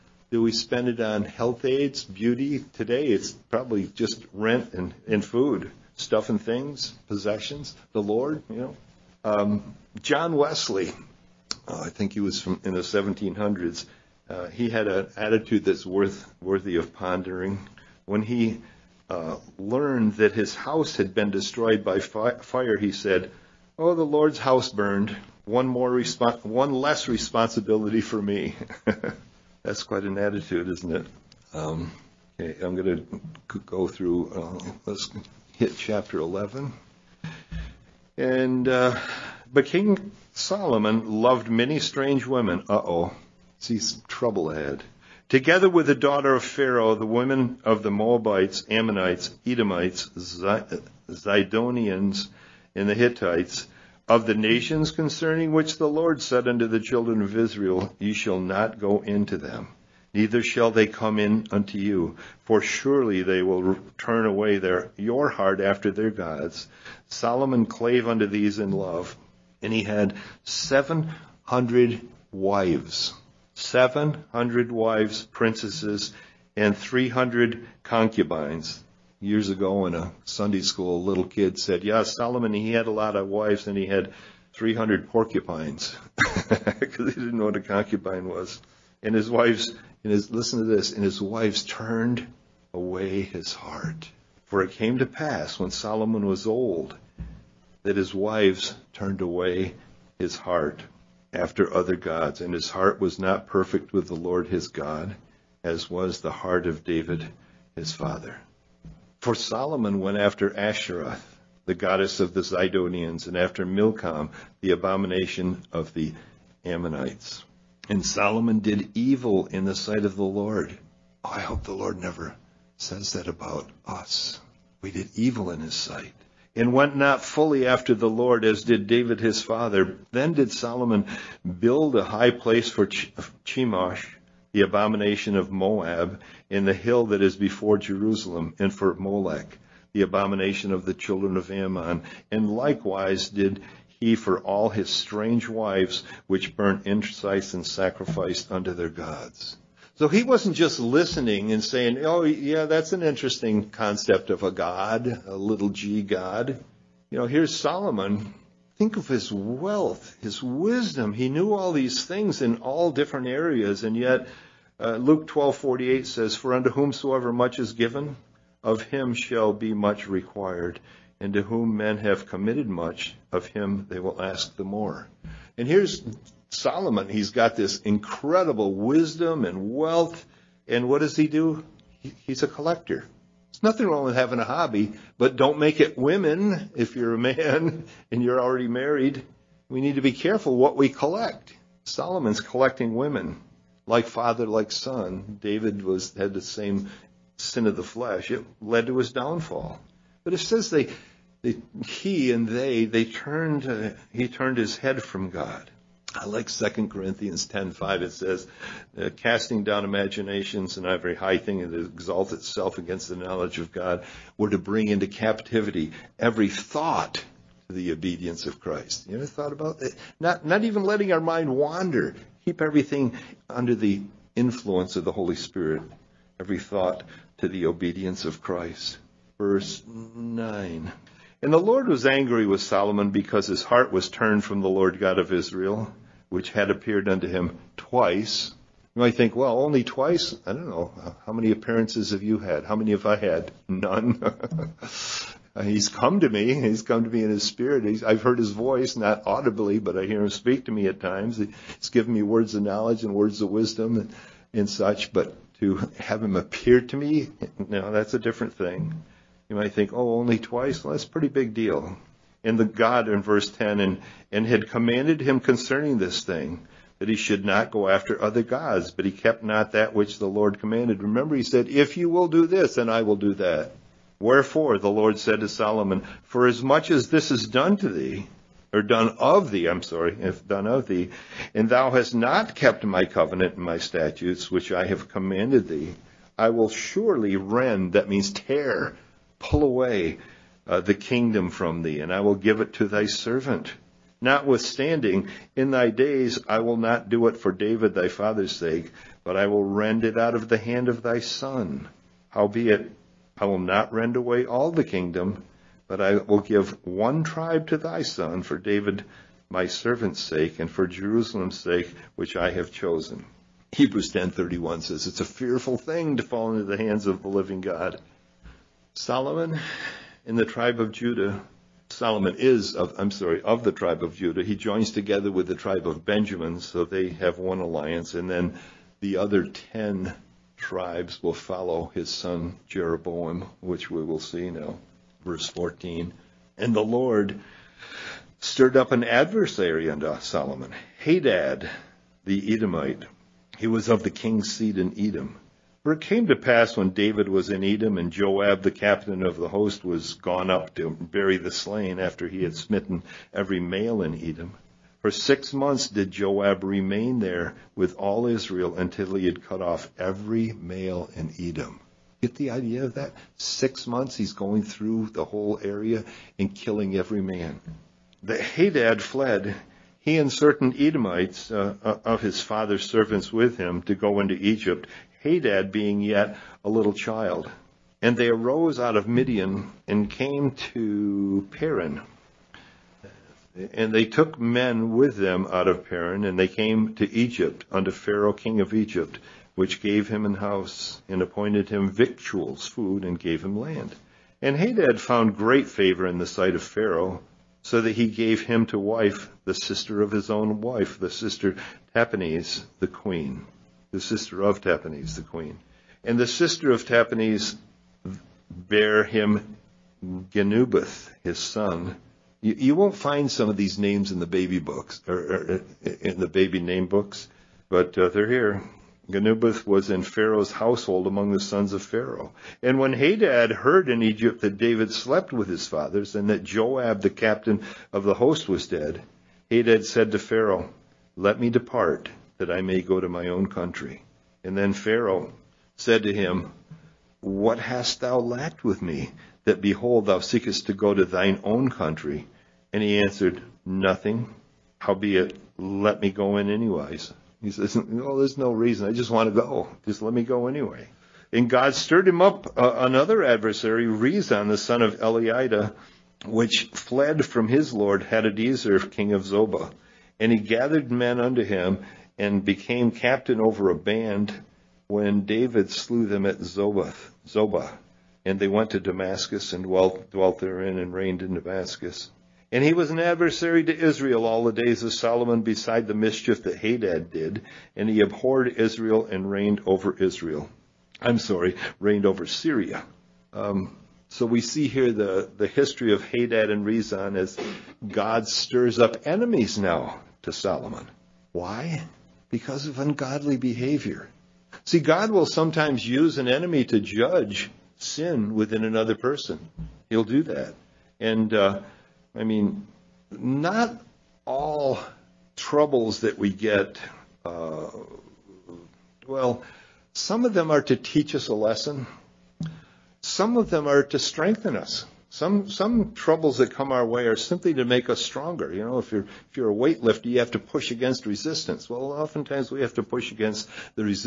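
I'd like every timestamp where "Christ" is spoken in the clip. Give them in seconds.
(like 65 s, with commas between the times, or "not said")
218 s, 228 s.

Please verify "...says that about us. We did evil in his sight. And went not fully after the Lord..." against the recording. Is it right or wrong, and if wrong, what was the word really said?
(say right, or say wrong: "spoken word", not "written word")
right.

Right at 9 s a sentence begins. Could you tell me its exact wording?
Um, John Wesley, uh, I think he was from in the 1700s.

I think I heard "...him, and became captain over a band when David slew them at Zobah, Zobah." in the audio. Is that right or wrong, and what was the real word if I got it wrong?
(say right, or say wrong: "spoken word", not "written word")
right.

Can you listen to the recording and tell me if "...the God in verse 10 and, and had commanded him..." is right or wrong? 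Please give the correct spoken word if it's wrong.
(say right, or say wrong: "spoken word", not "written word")
right.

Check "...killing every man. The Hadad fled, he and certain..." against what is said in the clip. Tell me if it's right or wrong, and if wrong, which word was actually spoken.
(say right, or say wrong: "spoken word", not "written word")
right.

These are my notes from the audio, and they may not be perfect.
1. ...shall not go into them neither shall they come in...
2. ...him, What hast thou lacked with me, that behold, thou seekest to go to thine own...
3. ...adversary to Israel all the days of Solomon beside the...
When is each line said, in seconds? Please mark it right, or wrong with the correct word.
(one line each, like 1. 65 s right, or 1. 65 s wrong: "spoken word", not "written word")
1. 58 s right
2. 436 s right
3. 473 s right.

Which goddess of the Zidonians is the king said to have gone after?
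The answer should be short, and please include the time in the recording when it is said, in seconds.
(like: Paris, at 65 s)
Asherah, at 110 s.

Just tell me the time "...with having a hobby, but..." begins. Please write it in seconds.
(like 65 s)
184 s.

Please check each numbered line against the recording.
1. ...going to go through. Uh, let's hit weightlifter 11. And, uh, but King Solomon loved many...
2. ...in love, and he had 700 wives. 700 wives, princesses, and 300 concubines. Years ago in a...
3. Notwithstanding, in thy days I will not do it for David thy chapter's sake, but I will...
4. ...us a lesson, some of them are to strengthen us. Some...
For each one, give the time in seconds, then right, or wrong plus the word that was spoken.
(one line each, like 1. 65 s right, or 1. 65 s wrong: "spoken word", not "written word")
1. 32 s wrong: "chapter", not "weightlifter"
2. 68 s right
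3. 294 s wrong: "father", not "chapter"
4. 511 s right.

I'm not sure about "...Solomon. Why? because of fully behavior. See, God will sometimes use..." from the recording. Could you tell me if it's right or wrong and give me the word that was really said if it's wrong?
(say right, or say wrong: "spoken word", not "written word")
wrong: "ungodly", not "fully".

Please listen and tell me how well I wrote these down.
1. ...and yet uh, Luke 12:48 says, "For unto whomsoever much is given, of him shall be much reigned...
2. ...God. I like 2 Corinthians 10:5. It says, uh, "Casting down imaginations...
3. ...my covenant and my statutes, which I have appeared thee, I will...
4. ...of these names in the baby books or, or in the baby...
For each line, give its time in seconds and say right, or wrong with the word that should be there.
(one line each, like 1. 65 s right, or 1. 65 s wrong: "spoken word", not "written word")
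1. 163 s wrong: "required", not "reigned"
2. 205 s right
3. 282 s wrong: "commanded", not "appeared"
4. 413 s right.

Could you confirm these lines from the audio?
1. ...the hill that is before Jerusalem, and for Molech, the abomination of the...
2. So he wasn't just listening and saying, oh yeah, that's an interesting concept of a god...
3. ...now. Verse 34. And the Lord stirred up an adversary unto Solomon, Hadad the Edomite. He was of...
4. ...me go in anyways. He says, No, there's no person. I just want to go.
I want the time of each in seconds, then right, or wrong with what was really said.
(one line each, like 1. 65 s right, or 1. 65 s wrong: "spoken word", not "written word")
1. 136 s right
2. 149 s right
3. 334 s wrong: "14", not "34"
4. 446 s wrong: "reason", not "person".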